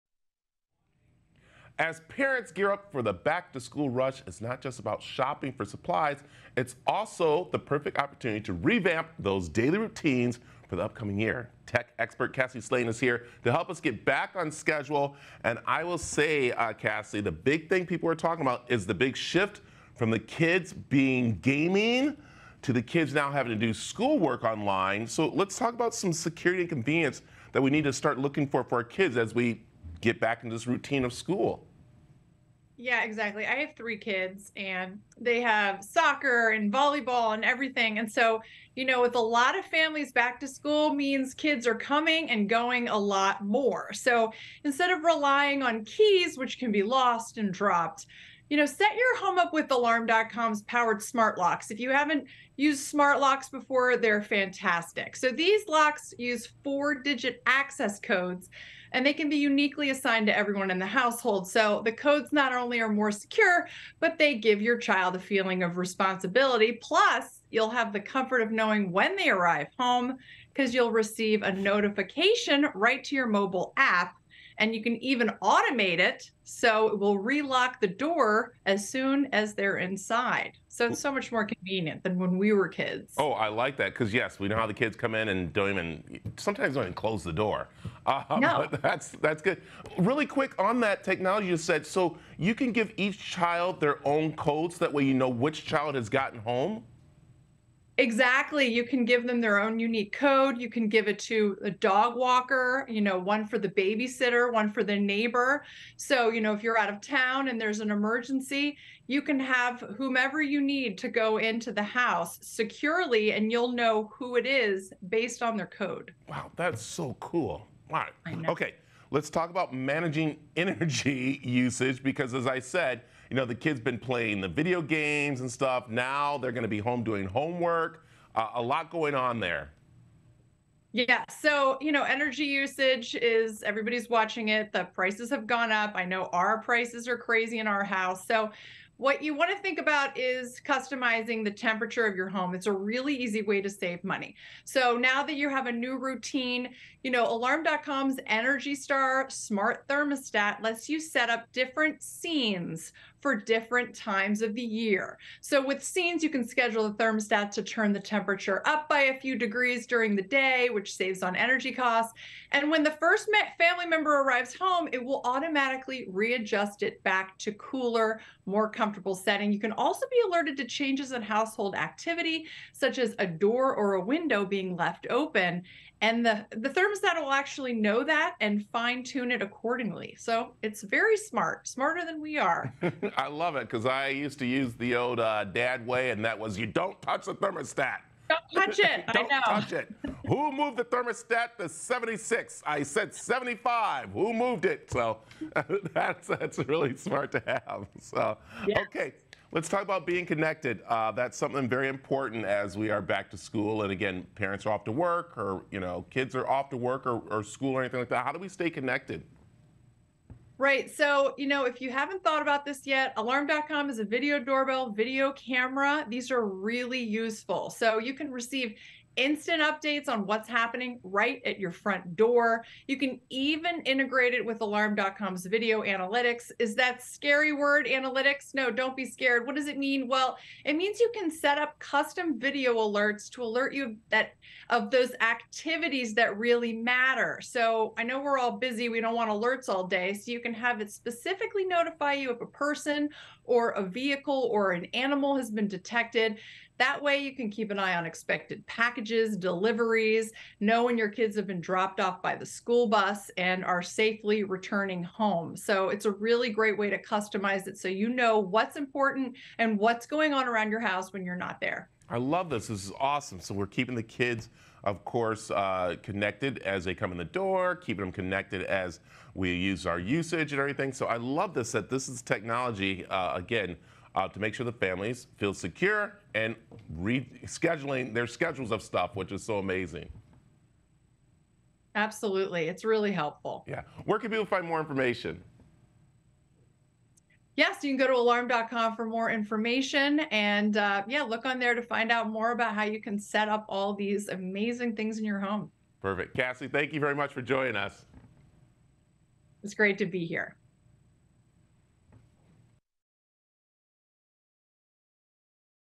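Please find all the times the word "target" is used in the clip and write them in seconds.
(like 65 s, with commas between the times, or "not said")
not said.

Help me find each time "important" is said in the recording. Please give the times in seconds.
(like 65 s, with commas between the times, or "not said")
201 s, 258 s.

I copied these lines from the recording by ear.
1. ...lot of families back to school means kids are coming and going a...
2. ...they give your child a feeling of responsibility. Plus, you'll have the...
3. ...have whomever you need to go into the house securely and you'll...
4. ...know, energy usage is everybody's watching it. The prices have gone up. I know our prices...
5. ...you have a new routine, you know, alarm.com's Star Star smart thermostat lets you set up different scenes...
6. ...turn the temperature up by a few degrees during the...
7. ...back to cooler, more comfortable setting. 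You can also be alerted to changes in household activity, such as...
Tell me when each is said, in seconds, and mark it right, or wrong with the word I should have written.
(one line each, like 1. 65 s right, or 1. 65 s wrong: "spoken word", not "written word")
1. 39 s right
2. 64 s right
3. 109 s right
4. 131 s right
5. 145 s wrong: "Energy", not "Star"
6. 157 s right
7. 167 s right.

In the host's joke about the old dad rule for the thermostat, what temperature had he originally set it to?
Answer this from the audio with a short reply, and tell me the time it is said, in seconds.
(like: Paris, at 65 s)
75, at 193 s.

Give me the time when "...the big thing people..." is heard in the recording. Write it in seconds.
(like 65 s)
17 s.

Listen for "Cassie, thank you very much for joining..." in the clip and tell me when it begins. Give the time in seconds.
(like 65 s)
296 s.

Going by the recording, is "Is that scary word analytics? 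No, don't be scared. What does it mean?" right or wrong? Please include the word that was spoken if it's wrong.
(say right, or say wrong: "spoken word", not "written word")
right.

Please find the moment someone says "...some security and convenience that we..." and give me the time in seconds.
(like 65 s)
25 s.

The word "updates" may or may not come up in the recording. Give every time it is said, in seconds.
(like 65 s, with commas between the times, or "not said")
219 s.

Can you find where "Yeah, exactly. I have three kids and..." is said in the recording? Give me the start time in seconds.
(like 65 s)
32 s.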